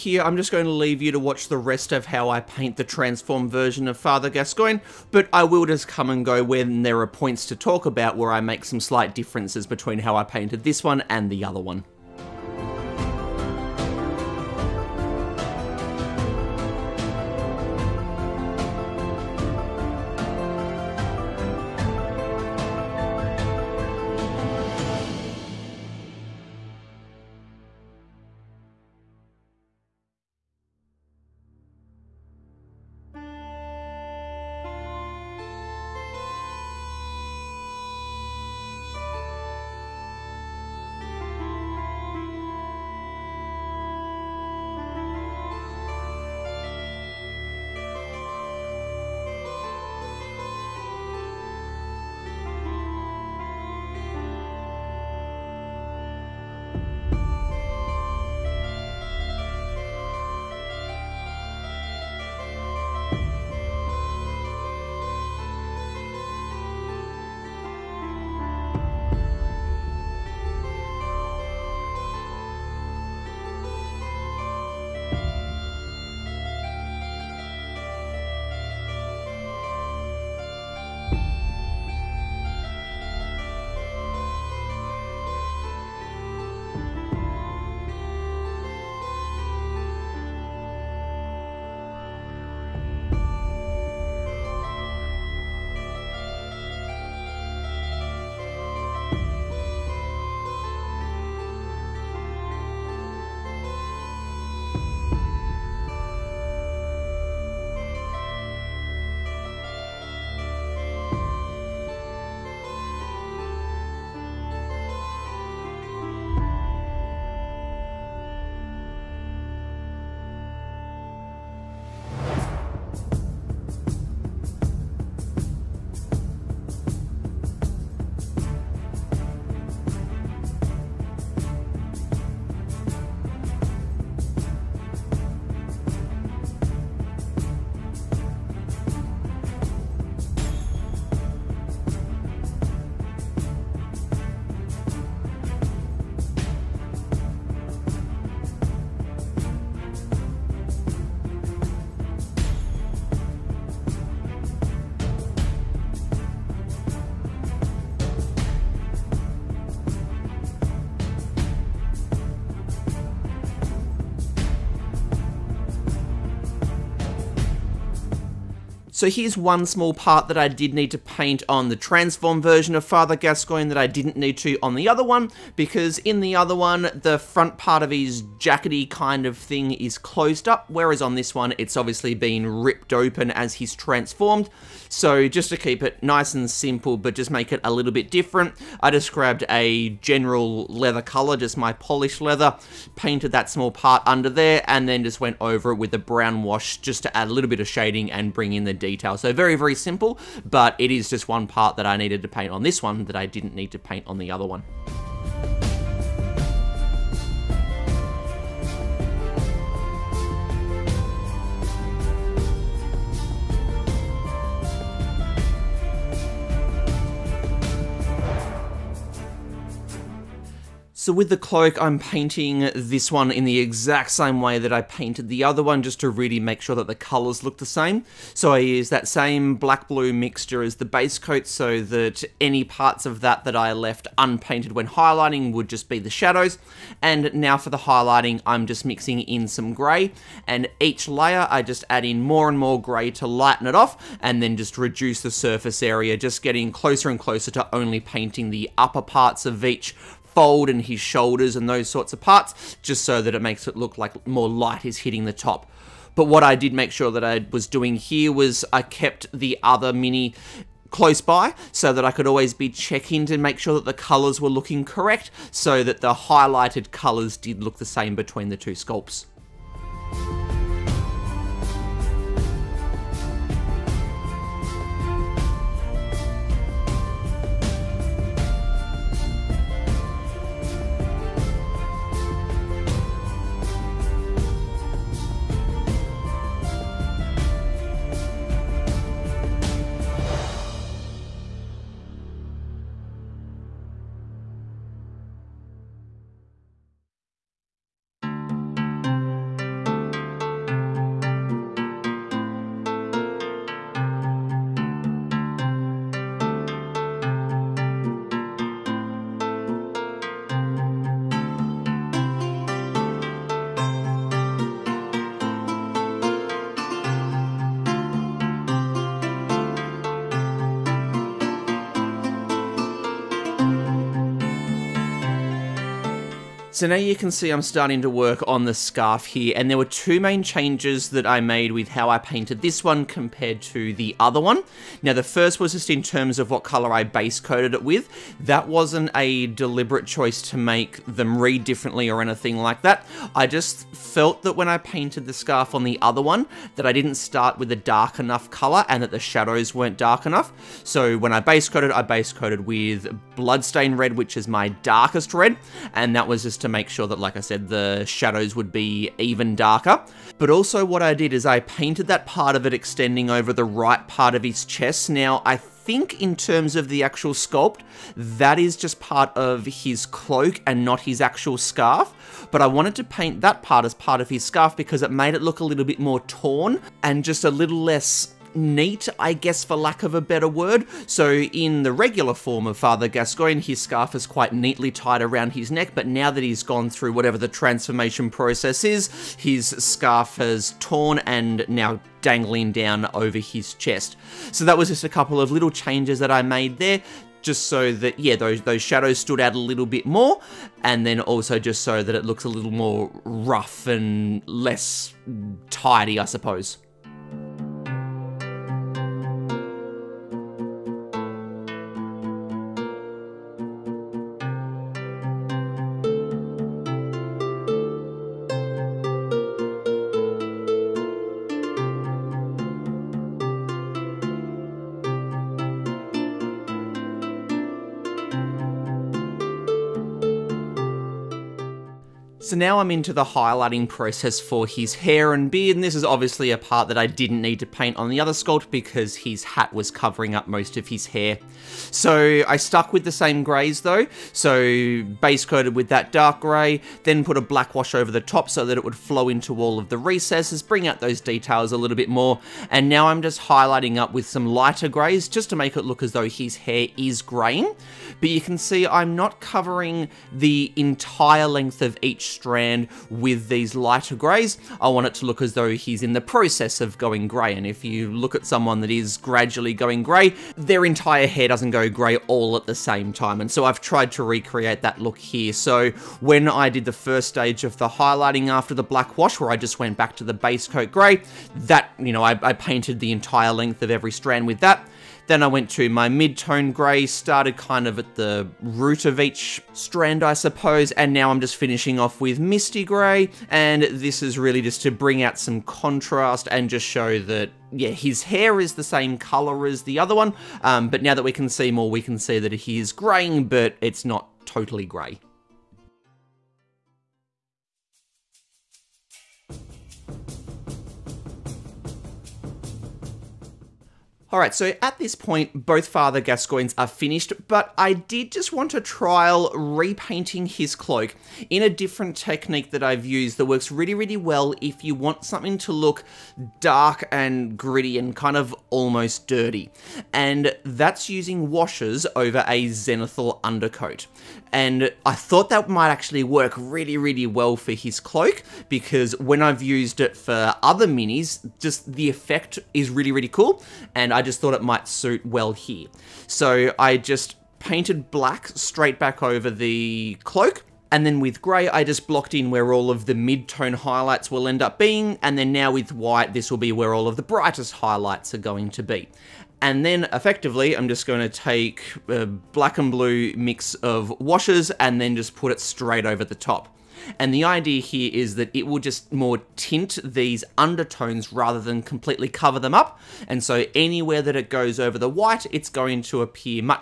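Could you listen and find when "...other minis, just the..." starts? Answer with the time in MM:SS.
09:00.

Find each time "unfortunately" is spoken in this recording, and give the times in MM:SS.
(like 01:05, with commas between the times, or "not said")
not said.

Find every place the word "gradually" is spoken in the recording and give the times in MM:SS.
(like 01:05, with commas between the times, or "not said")
07:49.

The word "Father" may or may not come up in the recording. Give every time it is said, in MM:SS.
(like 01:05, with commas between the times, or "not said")
00:03, 02:52, 06:22, 08:35.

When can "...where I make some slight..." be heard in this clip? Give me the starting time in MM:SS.
00:08.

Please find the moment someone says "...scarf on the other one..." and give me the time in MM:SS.
05:45.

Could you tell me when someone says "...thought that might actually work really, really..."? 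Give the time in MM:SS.
08:55.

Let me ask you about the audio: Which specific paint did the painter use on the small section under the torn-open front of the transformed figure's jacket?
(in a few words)
Polished leather.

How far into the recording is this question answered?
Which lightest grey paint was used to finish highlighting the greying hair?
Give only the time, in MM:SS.
08:12.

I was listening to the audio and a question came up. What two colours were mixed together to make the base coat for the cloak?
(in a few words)
Black and blue.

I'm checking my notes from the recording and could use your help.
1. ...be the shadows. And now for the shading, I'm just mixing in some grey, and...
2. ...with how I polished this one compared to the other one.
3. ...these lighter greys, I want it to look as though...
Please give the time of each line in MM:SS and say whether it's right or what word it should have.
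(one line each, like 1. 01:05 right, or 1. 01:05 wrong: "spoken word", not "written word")
1. 03:55 wrong: "highlighting", not "shading"
2. 05:31 wrong: "painted", not "polished"
3. 07:43 right.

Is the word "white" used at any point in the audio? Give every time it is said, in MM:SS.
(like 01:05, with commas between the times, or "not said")
09:15, 09:35.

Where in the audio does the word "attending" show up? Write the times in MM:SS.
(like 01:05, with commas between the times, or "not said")
not said.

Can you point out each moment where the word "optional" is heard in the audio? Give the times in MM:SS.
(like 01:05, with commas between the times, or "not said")
not said.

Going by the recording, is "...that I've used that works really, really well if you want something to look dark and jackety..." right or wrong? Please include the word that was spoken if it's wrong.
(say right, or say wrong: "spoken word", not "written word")
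wrong: "gritty", not "jackety".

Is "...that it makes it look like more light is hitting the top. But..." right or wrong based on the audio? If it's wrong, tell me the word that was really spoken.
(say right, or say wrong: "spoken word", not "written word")
right.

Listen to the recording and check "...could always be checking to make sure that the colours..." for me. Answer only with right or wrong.
right.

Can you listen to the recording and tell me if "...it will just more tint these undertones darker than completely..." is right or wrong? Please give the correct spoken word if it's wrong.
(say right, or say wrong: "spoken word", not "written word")
wrong: "rather", not "darker".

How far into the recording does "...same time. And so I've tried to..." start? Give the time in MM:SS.
07:52.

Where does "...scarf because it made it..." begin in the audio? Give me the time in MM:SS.
06:14.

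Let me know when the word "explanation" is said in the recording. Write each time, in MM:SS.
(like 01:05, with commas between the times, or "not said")
not said.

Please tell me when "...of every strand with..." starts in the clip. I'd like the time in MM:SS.
08:03.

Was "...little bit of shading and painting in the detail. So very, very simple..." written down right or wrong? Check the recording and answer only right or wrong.
wrong.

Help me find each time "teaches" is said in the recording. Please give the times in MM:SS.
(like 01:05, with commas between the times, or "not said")
not said.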